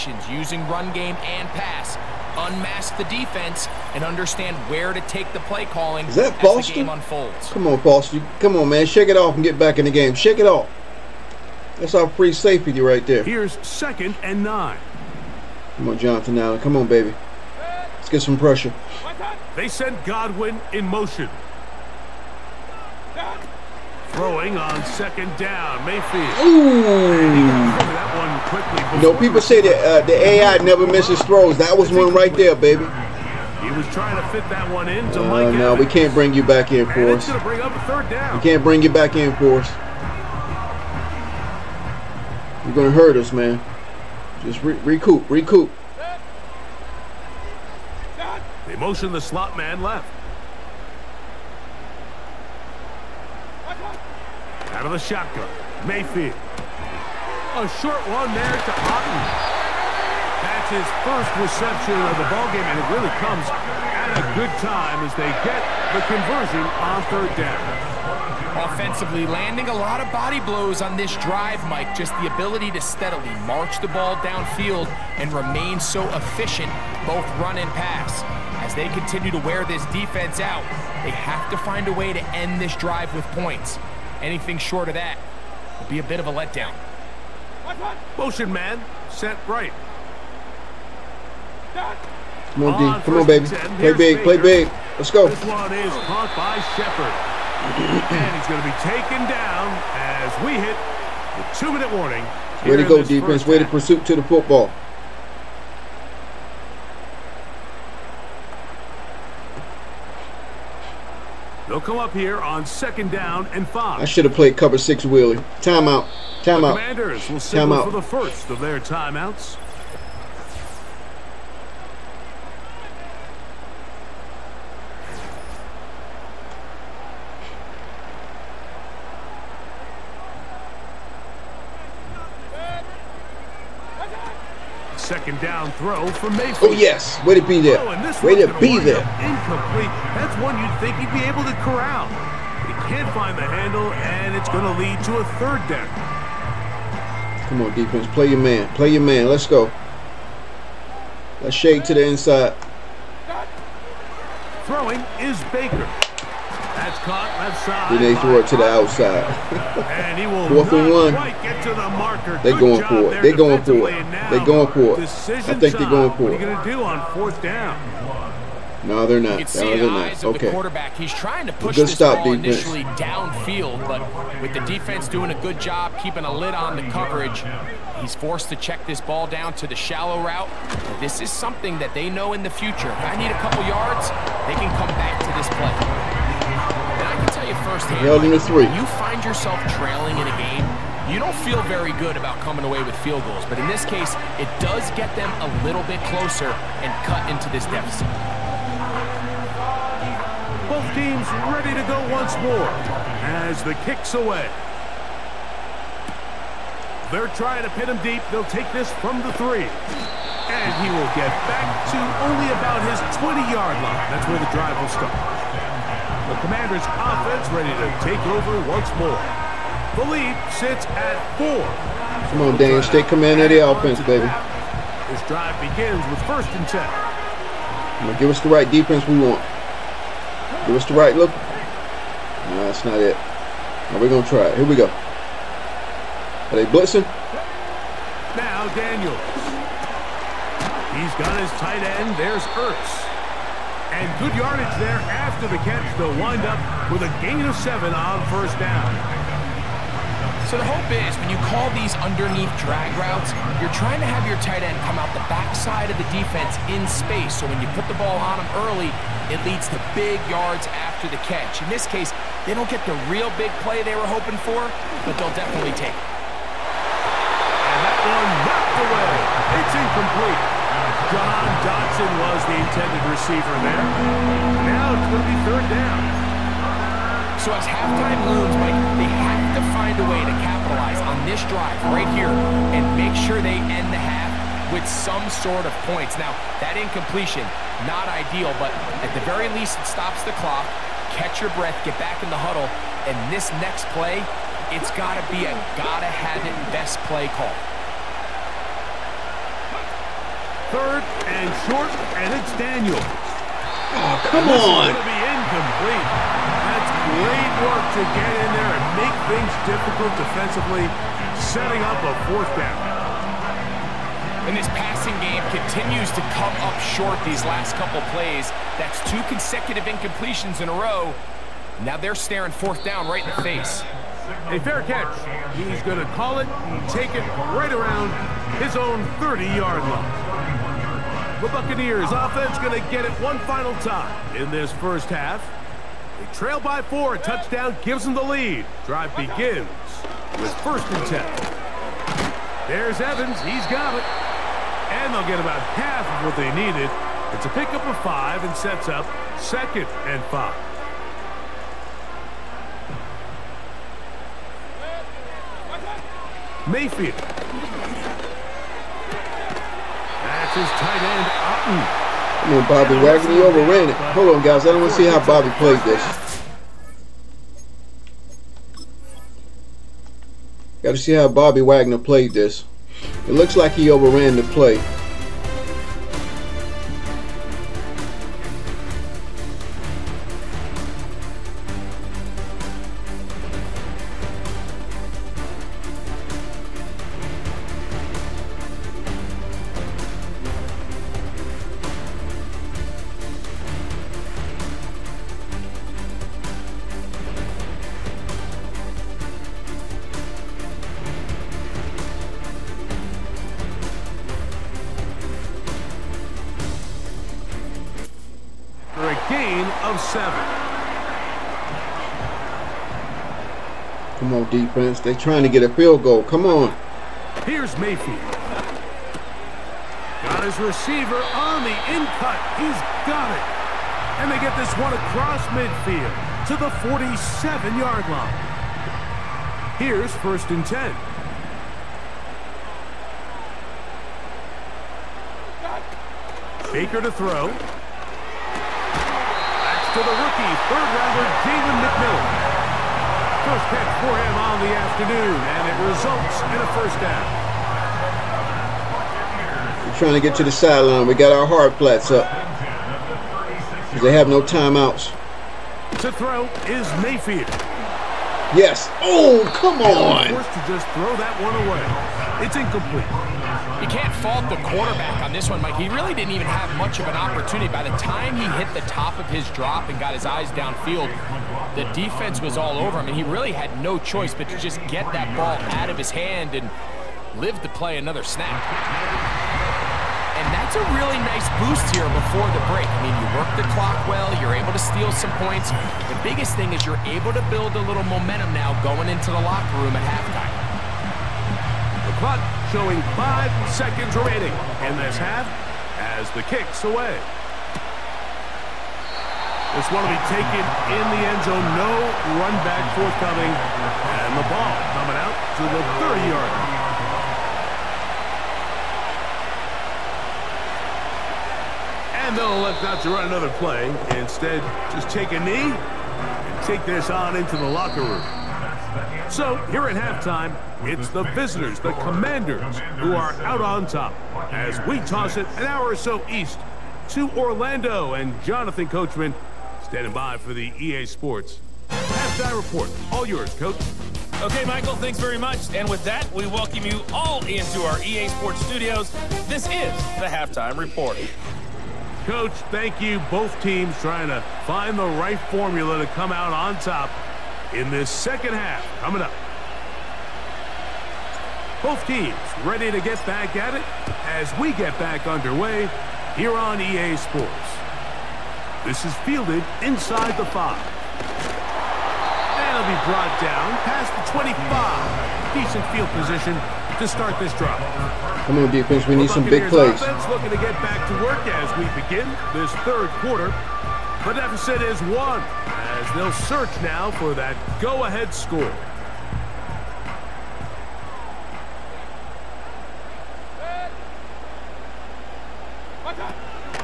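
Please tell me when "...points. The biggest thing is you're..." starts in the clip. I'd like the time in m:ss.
8:05.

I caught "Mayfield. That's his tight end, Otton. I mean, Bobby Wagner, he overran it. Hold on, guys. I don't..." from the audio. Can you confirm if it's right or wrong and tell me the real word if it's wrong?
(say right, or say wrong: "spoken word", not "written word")
right.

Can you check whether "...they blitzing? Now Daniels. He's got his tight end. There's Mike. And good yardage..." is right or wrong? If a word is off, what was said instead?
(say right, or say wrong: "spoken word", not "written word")
wrong: "Ertz", not "Mike".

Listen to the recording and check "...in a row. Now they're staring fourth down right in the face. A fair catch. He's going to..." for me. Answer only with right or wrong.
right.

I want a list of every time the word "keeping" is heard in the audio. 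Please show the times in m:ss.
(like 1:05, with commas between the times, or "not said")
2:56.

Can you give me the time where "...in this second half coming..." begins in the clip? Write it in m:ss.
9:07.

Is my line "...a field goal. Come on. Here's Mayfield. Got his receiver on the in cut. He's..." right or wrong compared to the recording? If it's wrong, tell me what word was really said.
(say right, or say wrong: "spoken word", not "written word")
right.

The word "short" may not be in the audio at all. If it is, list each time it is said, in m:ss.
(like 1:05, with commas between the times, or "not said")
0:57, 1:24, 5:01, 5:16.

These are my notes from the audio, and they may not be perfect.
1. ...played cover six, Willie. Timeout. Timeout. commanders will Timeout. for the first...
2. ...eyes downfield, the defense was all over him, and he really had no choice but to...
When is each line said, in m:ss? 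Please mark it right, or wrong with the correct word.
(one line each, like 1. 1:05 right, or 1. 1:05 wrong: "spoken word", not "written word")
1. 1:54 right
2. 7:50 right.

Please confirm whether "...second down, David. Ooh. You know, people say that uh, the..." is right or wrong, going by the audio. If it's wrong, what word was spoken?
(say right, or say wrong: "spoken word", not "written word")
wrong: "Mayfield", not "David".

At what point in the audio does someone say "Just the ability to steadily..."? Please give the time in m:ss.
1:11.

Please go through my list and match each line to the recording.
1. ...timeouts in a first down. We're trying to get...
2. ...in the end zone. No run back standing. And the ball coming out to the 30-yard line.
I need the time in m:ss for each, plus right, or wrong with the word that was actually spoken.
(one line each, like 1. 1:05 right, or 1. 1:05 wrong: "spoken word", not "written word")
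1. 7:25 wrong: "results", not "timeouts"
2. 8:20 wrong: "forthcoming", not "standing".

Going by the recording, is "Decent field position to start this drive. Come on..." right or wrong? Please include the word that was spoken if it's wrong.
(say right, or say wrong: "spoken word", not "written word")
right.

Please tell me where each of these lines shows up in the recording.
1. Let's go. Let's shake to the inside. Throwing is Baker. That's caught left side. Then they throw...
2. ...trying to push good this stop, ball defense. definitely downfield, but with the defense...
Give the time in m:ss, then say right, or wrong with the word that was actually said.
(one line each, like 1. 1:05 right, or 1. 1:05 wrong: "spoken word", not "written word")
1. 2:29 right
2. 2:51 wrong: "initially", not "definitely".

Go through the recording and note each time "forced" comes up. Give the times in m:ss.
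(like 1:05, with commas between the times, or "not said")
2:58, 7:40.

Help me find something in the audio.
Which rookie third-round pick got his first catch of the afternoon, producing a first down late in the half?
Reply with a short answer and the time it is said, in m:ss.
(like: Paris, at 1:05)
David McMillan, at 7:21.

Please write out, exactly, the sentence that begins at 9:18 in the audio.
This is fielded inside the five.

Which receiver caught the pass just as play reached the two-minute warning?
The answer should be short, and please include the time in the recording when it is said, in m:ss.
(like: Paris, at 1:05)
Shepard, at 1:35.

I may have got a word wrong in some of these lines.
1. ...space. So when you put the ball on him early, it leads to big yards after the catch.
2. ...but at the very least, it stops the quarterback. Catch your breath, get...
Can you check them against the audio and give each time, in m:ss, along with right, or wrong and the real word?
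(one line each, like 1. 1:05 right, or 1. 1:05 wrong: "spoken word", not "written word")
1. 4:16 right
2. 4:48 wrong: "clock", not "quarterback".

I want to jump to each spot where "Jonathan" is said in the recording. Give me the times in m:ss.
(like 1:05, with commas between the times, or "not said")
0:15, 8:48.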